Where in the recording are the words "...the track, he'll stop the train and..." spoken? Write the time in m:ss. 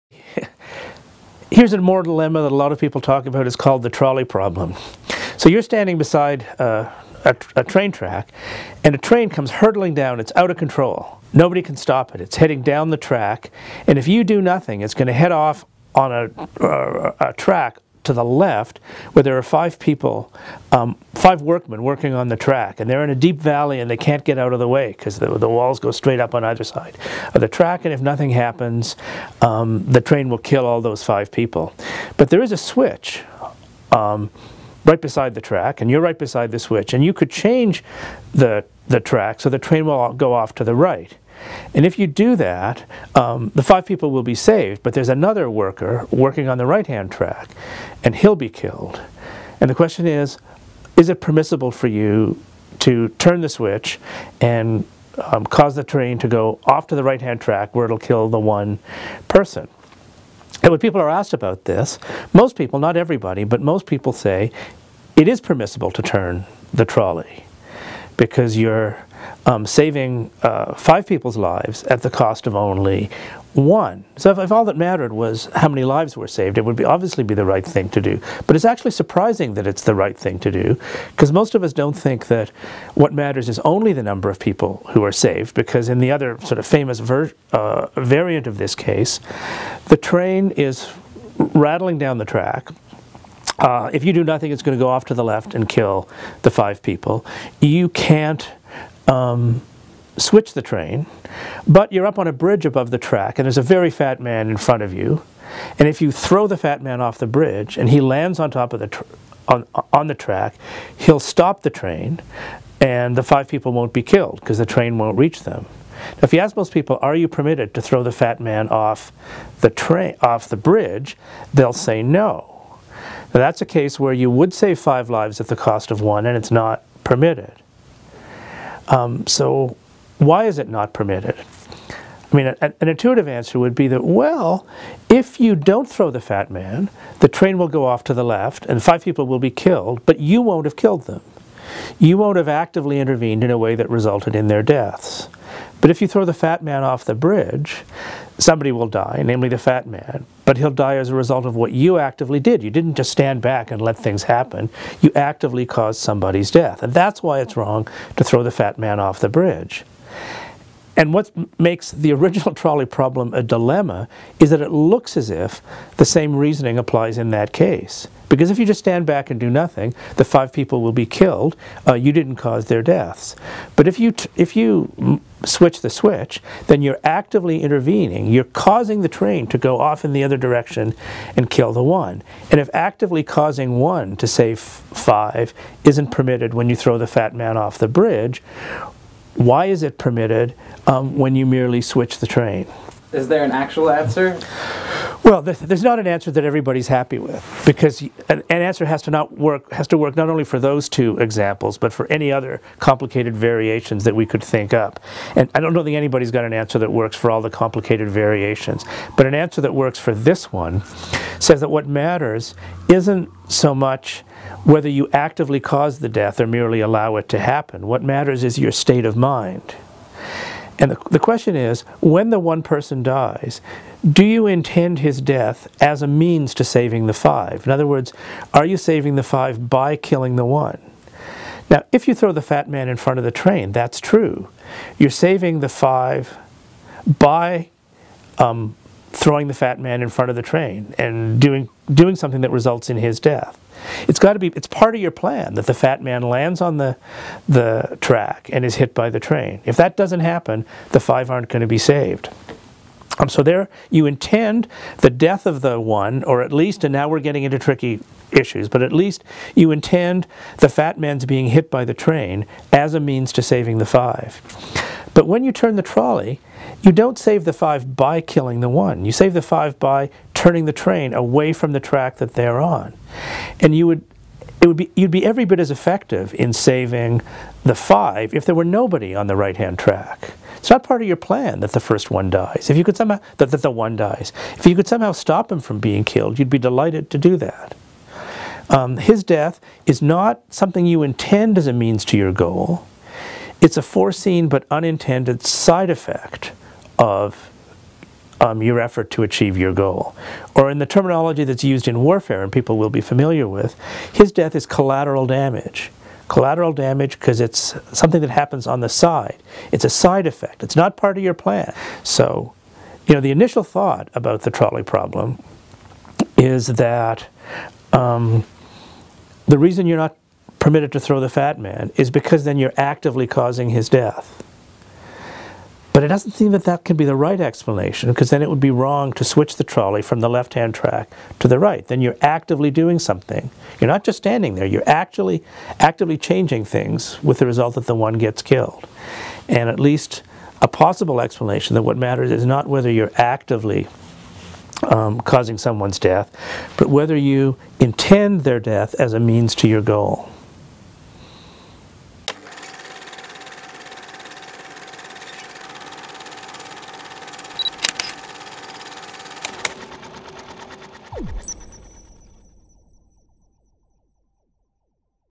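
1:50.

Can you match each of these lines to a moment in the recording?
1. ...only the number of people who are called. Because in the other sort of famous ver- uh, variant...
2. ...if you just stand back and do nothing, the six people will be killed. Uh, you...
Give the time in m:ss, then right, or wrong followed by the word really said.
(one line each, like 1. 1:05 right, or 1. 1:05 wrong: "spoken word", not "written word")
1. 1:23 wrong: "saved", not "called"
2. 2:48 wrong: "five", not "six".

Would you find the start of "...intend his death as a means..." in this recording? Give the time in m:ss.
3:44.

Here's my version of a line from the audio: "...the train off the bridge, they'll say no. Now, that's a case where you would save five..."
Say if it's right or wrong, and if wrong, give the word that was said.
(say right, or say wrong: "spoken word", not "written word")
right.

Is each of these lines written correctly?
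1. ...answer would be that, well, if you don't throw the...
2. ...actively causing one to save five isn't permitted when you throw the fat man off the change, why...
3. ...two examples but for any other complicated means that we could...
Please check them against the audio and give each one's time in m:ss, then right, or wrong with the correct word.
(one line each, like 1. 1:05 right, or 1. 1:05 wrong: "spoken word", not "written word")
1. 2:13 right
2. 3:02 wrong: "bridge", not "change"
3. 3:20 wrong: "variations", not "means".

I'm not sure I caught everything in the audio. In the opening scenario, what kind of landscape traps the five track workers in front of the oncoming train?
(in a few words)
A deep valley.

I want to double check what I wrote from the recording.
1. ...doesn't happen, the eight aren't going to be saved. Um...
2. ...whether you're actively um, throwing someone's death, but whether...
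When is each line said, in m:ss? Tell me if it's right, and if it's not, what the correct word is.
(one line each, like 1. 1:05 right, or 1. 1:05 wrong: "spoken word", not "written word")
1. 4:09 wrong: "five", not "eight"
2. 5:42 wrong: "causing", not "throwing".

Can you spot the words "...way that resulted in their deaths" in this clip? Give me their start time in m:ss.
2:23.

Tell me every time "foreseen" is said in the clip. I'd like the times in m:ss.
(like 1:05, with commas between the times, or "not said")
4:53.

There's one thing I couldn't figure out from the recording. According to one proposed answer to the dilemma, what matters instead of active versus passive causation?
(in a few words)
Your state of mind.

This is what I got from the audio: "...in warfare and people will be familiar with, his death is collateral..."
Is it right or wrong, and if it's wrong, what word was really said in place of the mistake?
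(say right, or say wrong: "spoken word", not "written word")
right.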